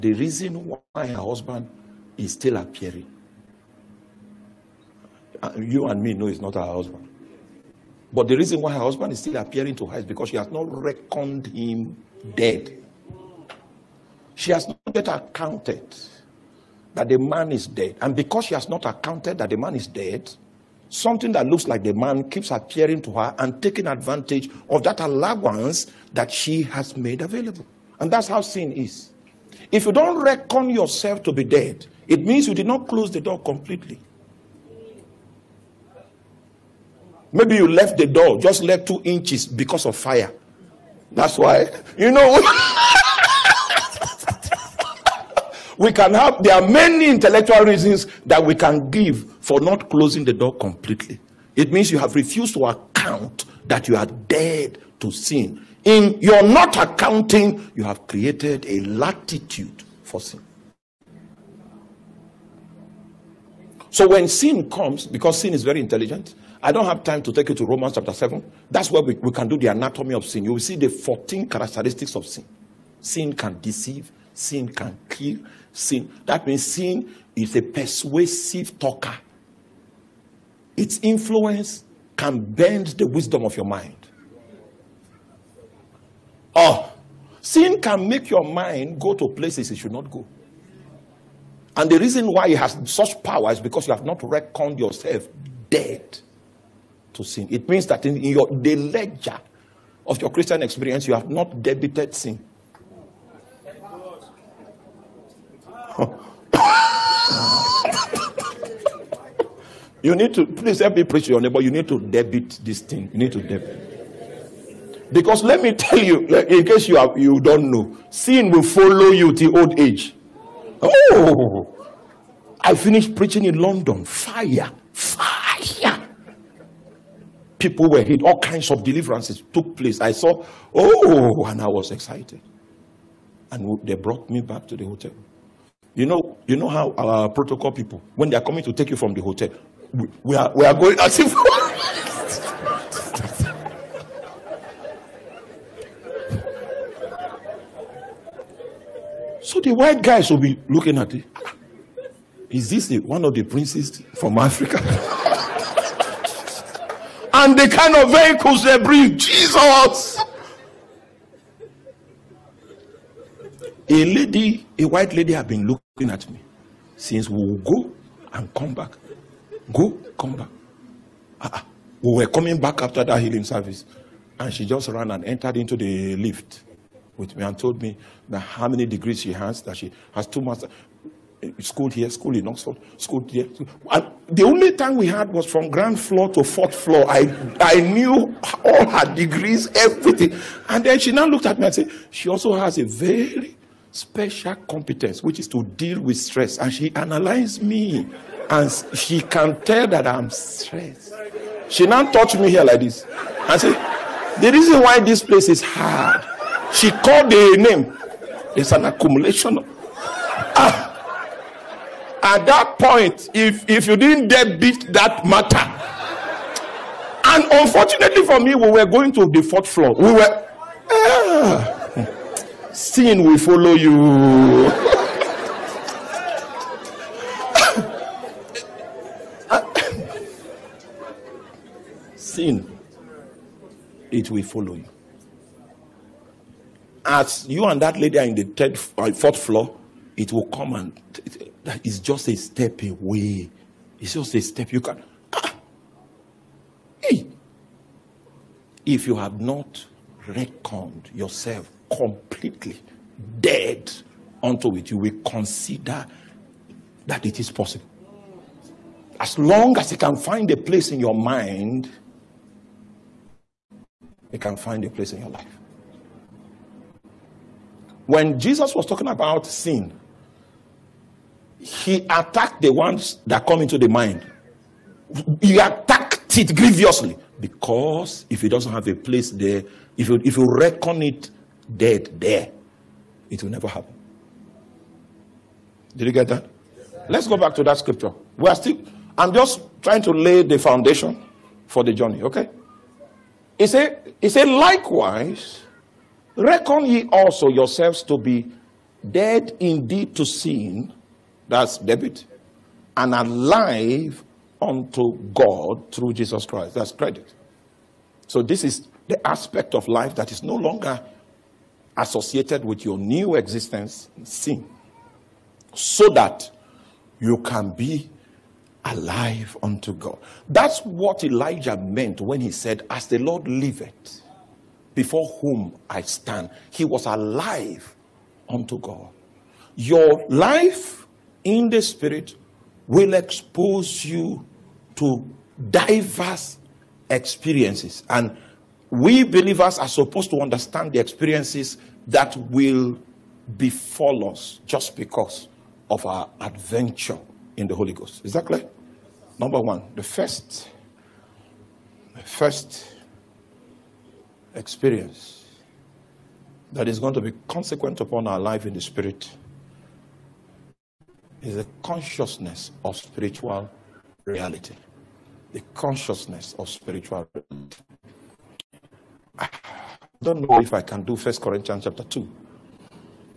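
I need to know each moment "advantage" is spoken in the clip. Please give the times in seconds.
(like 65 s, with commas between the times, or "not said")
23 s.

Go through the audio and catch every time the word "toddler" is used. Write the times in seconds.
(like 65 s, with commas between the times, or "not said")
not said.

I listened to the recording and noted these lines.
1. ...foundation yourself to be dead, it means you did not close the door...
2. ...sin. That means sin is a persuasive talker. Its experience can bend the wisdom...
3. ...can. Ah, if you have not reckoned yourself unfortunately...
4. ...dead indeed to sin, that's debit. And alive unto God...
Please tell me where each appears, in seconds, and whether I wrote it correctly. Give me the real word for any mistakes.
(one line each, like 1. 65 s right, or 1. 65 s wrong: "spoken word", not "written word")
1. 30 s wrong: "reckon", not "foundation"
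2. 75 s wrong: "influence", not "experience"
3. 244 s wrong: "completely", not "unfortunately"
4. 299 s right.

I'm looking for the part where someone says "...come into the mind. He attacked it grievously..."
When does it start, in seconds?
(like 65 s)
273 s.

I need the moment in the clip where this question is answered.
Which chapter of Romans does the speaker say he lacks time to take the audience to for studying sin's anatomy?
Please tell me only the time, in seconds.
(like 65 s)
67 s.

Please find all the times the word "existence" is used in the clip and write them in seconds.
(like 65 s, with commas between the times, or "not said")
313 s.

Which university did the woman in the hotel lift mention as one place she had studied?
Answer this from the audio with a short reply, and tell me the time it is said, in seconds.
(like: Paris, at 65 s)
Oxford, at 182 s.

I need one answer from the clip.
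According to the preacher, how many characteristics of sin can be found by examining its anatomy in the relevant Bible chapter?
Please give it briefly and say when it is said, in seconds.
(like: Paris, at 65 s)
14, at 70 s.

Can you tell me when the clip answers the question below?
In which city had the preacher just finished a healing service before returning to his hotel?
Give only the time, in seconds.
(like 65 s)
123 s.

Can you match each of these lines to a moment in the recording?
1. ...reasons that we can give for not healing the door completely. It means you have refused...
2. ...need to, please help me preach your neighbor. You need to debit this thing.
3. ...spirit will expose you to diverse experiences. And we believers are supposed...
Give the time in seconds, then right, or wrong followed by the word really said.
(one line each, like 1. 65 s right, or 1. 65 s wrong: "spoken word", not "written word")
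1. 47 s wrong: "closing", not "healing"
2. 110 s right
3. 331 s right.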